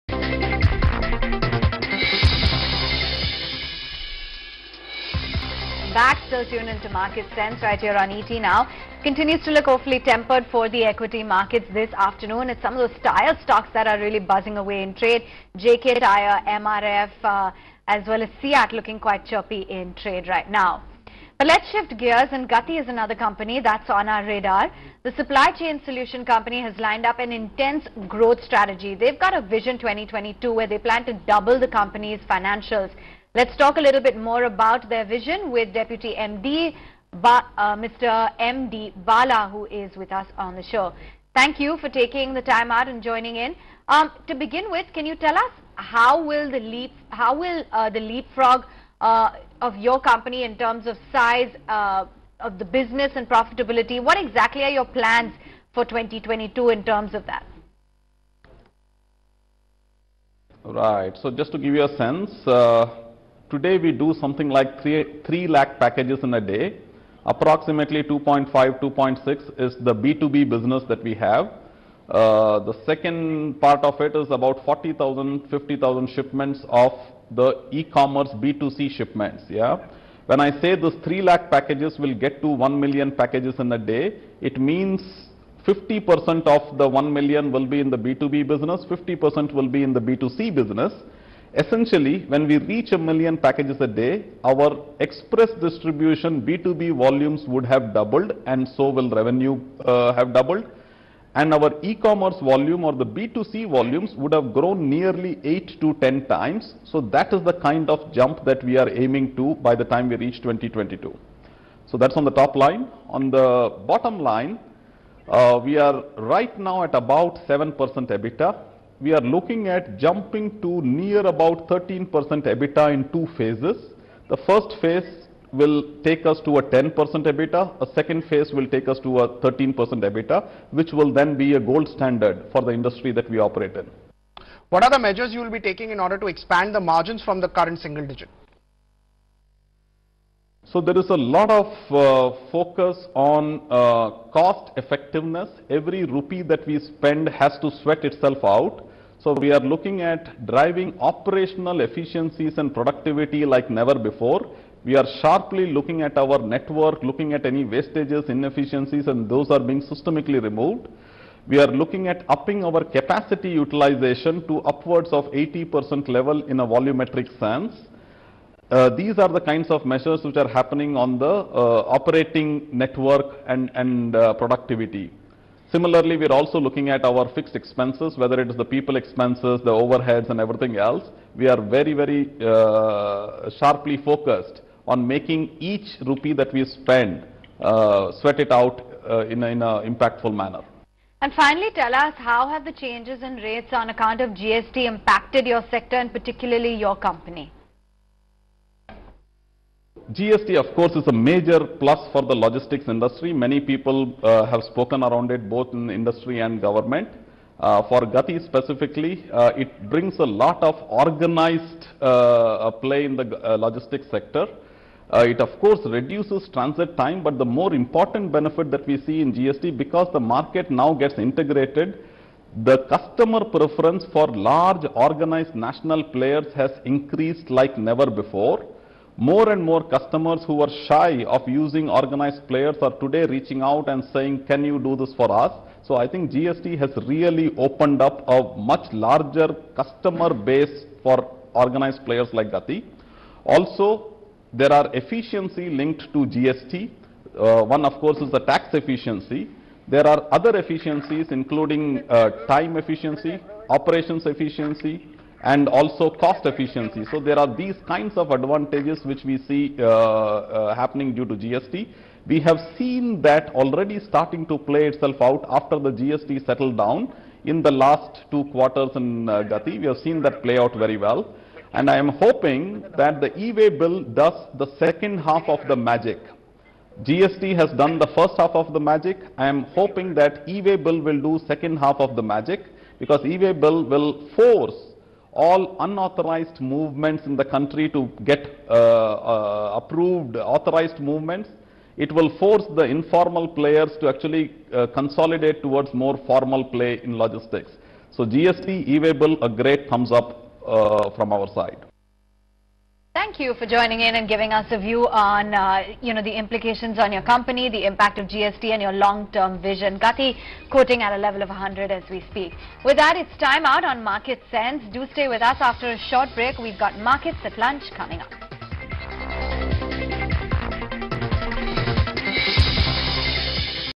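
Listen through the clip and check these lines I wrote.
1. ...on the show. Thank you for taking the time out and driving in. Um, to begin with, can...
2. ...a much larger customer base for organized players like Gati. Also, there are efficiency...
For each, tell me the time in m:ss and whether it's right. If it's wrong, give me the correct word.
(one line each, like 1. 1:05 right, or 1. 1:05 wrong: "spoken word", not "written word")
1. 0:40 wrong: "joining", not "driving"
2. 3:58 right.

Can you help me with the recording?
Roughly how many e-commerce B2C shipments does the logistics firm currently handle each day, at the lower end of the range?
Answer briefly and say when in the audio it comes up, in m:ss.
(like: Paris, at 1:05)
40,000, at 1:14.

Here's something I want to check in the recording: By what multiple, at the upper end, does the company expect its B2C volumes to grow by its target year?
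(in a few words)
10 times.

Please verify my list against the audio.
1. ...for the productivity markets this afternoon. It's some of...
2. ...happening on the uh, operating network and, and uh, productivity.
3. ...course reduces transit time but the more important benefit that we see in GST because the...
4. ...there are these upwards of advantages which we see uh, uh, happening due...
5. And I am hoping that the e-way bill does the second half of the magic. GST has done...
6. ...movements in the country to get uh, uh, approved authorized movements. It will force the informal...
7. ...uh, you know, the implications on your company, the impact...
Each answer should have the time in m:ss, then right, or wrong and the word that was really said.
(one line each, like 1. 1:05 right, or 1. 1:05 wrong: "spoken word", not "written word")
1. 0:10 wrong: "equity", not "productivity"
2. 2:50 right
3. 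3:35 right
4. 4:17 wrong: "kinds", not "upwards"
5. 4:31 right
6. 4:46 right
7. 5:05 right.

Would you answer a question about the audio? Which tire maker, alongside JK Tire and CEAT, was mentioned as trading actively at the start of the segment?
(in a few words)
MRF.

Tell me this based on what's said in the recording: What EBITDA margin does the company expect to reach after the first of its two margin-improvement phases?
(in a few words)
10%.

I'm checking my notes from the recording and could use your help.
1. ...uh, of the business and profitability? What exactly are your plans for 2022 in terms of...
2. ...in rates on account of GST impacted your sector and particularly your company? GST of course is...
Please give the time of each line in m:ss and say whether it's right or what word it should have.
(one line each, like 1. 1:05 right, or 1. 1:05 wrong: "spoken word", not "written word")
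1. 0:51 right
2. 3:13 right.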